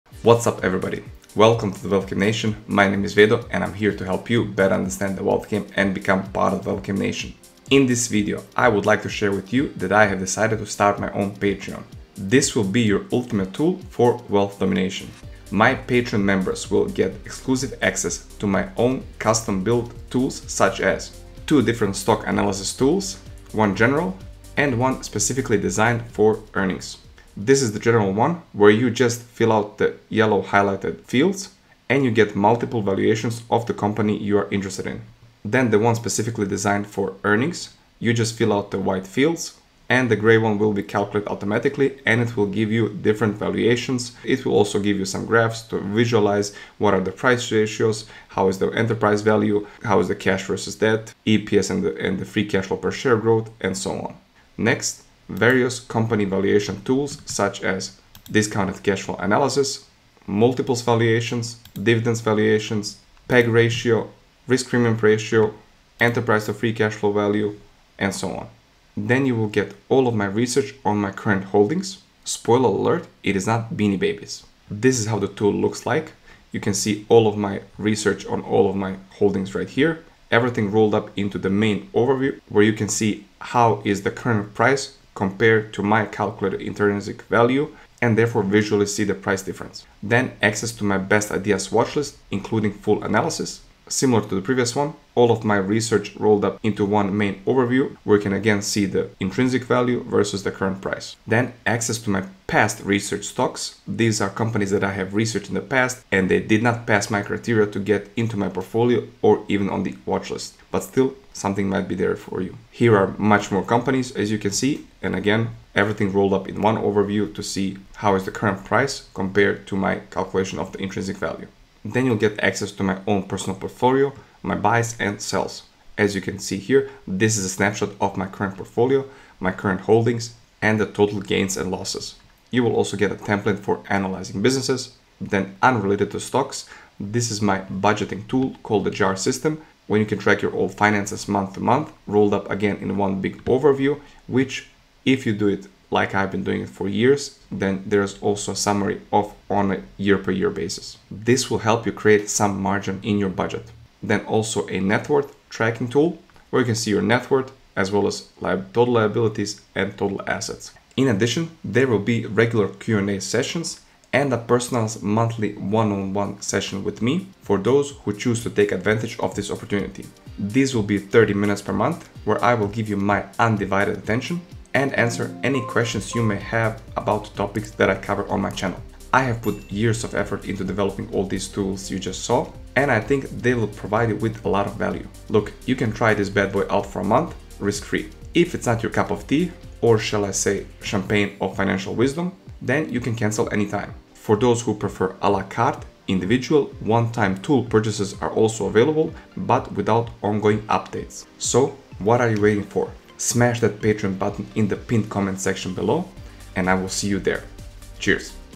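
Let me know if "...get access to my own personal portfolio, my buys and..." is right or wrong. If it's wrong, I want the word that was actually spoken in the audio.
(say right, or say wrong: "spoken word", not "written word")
right.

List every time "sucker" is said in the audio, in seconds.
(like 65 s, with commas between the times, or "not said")
not said.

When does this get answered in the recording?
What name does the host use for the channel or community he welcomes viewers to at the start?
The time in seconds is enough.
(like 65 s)
1 s.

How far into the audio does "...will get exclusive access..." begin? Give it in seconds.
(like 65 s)
16 s.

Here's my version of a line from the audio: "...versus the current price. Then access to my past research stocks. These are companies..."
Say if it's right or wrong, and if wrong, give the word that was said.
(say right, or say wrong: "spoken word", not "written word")
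right.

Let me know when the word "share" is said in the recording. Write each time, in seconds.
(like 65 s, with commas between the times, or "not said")
9 s, 52 s.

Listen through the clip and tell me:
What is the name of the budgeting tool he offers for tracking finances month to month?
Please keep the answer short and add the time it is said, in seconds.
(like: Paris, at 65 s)
JAR system, at 138 s.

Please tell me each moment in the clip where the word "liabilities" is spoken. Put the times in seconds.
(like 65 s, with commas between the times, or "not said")
158 s.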